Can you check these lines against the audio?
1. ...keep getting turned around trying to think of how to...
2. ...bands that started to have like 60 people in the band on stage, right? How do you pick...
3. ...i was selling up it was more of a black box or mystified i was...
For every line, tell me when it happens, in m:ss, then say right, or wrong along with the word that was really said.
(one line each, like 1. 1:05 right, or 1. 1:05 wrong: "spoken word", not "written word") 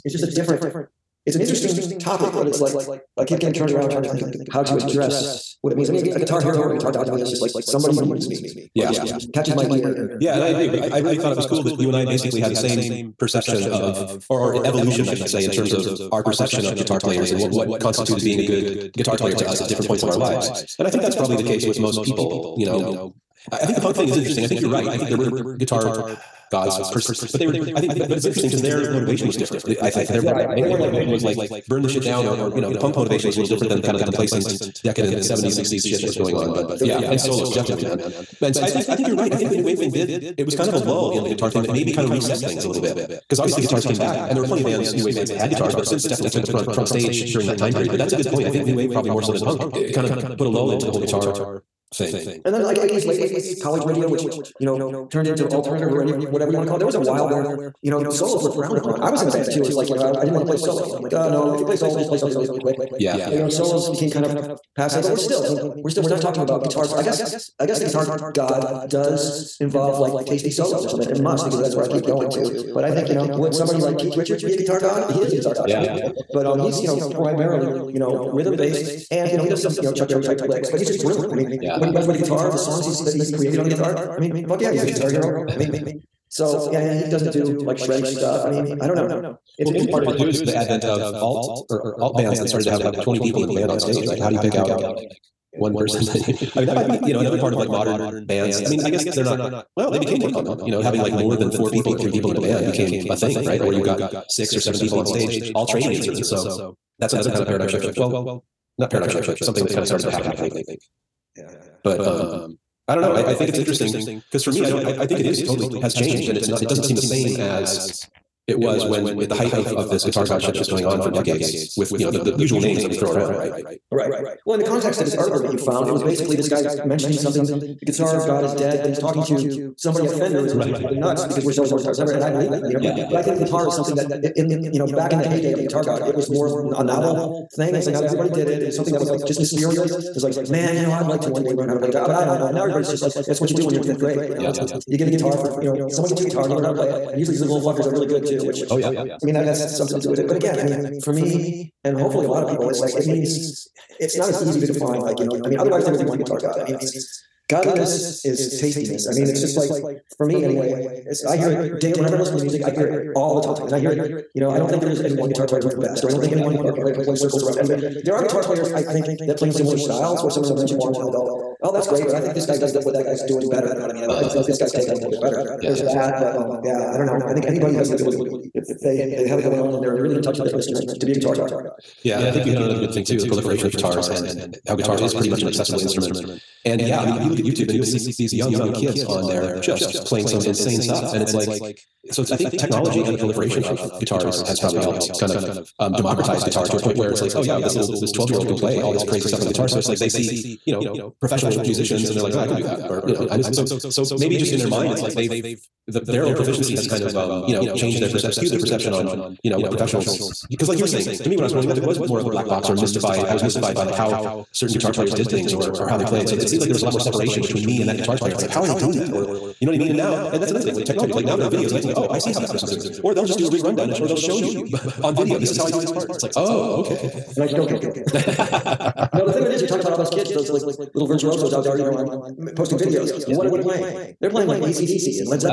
1. 0:03 right
2. 1:32 wrong: "20", not "60"
3. 3:31 wrong: "growing", not "selling".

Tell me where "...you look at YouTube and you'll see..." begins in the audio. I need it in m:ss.
3:07.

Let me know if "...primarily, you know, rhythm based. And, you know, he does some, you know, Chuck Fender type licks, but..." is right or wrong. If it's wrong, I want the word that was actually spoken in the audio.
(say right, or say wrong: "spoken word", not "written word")
wrong: "Berry", not "Fender".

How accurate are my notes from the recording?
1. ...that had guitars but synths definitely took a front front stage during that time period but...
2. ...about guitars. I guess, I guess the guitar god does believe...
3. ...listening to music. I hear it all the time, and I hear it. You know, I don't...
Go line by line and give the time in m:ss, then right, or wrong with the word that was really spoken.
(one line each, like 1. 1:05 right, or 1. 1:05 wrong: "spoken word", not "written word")
1. 0:45 right
2. 1:06 wrong: "involve", not "believe"
3. 2:42 right.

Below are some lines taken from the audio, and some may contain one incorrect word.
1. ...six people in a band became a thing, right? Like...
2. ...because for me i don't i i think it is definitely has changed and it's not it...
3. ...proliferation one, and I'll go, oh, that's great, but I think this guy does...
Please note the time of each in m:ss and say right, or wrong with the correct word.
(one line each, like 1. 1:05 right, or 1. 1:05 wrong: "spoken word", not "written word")
1. 1:41 wrong: "three", not "six"
2. 1:54 wrong: "totally", not "definitely"
3. 2:50 wrong: "mention", not "proliferation".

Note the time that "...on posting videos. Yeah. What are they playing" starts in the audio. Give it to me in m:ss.
3:51.